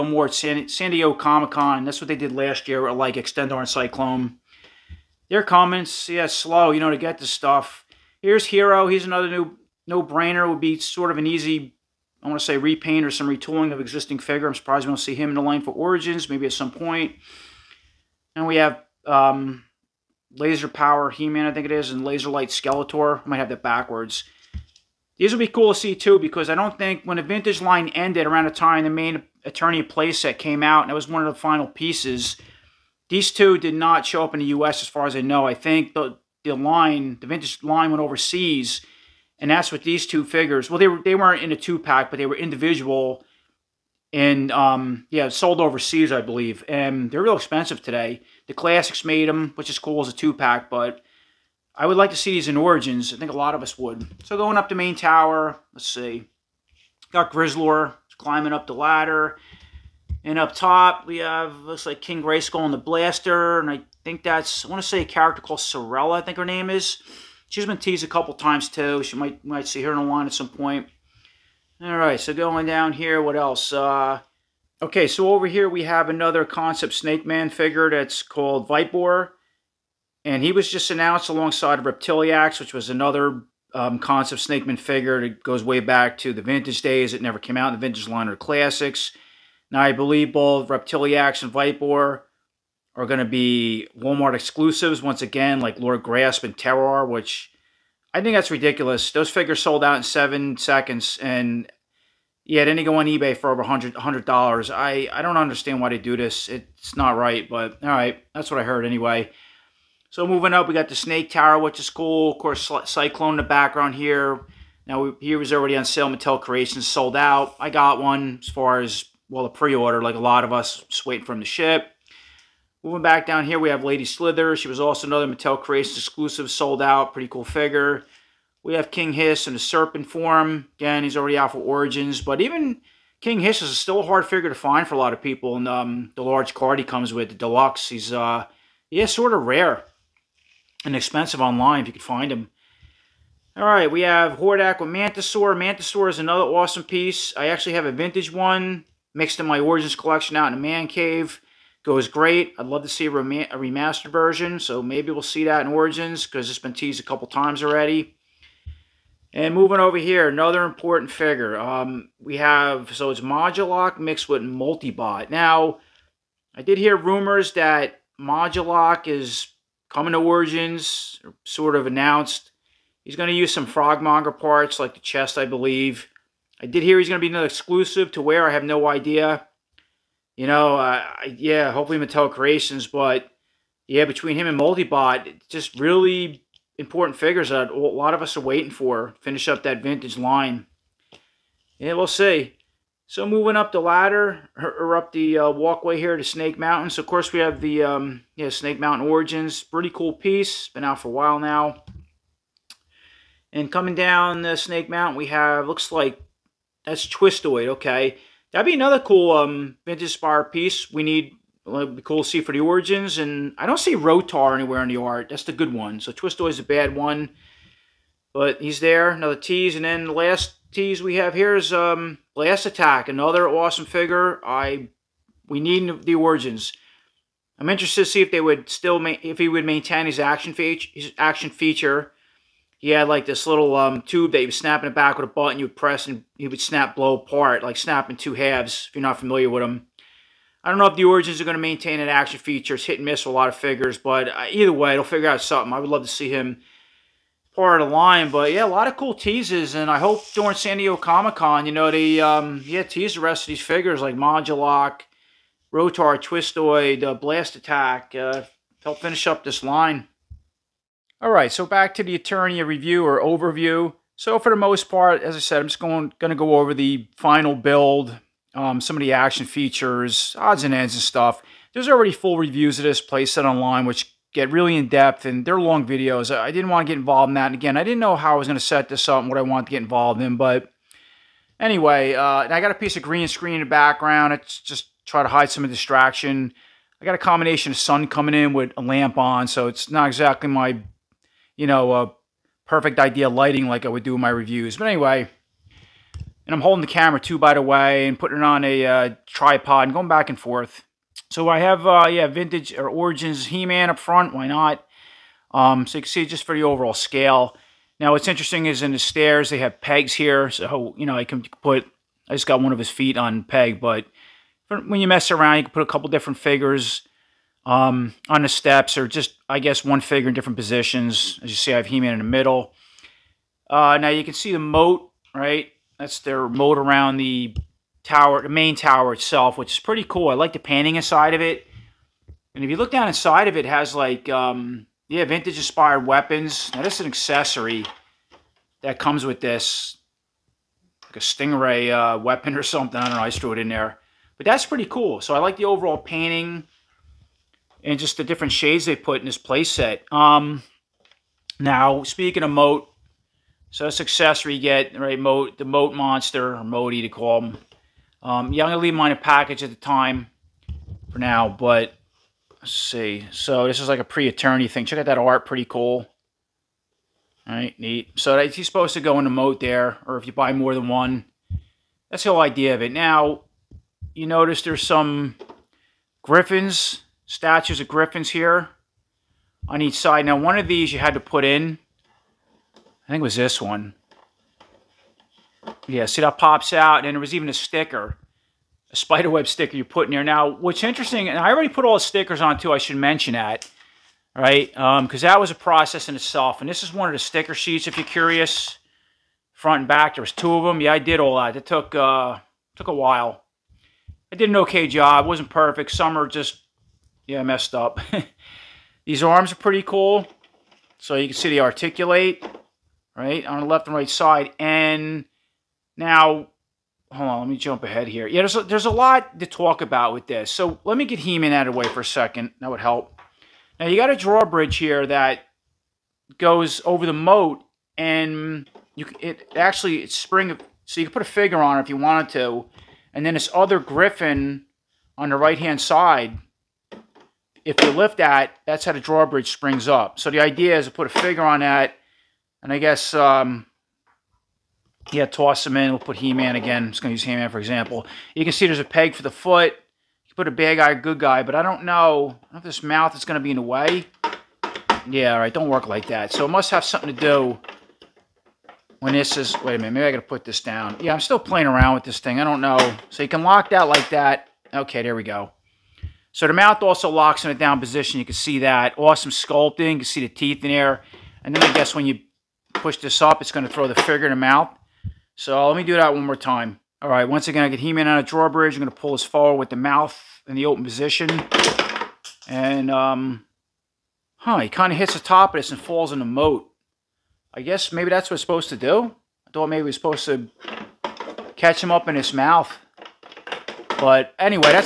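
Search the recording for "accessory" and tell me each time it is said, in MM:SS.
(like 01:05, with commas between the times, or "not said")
05:37, 05:54.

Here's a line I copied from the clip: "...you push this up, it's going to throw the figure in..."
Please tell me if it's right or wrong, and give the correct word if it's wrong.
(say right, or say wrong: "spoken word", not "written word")
right.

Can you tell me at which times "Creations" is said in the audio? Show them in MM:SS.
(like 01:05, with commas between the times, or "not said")
01:56, 02:05, 03:02.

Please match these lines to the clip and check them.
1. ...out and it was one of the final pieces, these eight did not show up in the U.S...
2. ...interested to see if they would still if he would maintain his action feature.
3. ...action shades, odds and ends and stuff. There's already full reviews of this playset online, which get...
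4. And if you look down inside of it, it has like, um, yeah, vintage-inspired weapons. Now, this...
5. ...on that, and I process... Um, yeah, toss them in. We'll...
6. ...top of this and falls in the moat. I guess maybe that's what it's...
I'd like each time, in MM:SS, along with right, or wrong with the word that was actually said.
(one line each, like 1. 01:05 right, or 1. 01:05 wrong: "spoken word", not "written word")
1. 00:30 wrong: "two", not "eight"
2. 03:47 right
3. 04:29 wrong: "features", not "shades"
4. 05:32 right
5. 07:21 wrong: "guess", not "process"
6. 08:05 right.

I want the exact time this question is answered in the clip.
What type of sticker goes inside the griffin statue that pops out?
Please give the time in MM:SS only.
06:28.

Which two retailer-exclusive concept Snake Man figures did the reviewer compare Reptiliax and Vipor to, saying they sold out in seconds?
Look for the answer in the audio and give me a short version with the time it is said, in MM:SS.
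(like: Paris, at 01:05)
Lord Grasp and Terror, at 01:35.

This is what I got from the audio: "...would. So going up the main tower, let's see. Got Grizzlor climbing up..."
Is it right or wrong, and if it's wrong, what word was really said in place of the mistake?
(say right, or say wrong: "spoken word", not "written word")
right.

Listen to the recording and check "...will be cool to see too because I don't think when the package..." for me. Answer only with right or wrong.
wrong.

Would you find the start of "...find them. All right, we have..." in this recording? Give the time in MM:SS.
02:22.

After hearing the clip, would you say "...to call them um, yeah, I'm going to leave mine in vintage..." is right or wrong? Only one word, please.
wrong.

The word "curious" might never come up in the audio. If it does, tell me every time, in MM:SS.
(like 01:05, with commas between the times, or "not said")
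06:38.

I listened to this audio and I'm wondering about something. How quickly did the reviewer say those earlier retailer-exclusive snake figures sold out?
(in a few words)
7 seconds.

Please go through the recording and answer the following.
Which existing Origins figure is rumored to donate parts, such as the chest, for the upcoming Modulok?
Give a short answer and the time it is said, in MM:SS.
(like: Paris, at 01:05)
Frogmonger, at 02:53.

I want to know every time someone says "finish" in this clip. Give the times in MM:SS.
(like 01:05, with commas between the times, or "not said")
03:09, 04:19.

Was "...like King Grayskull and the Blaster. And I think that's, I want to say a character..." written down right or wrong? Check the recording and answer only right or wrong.
right.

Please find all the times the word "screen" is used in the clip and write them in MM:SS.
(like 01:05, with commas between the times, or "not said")
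04:43.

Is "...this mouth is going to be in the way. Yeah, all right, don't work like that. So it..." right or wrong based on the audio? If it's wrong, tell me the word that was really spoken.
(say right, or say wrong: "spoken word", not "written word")
right.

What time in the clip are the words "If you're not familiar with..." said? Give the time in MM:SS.
03:58.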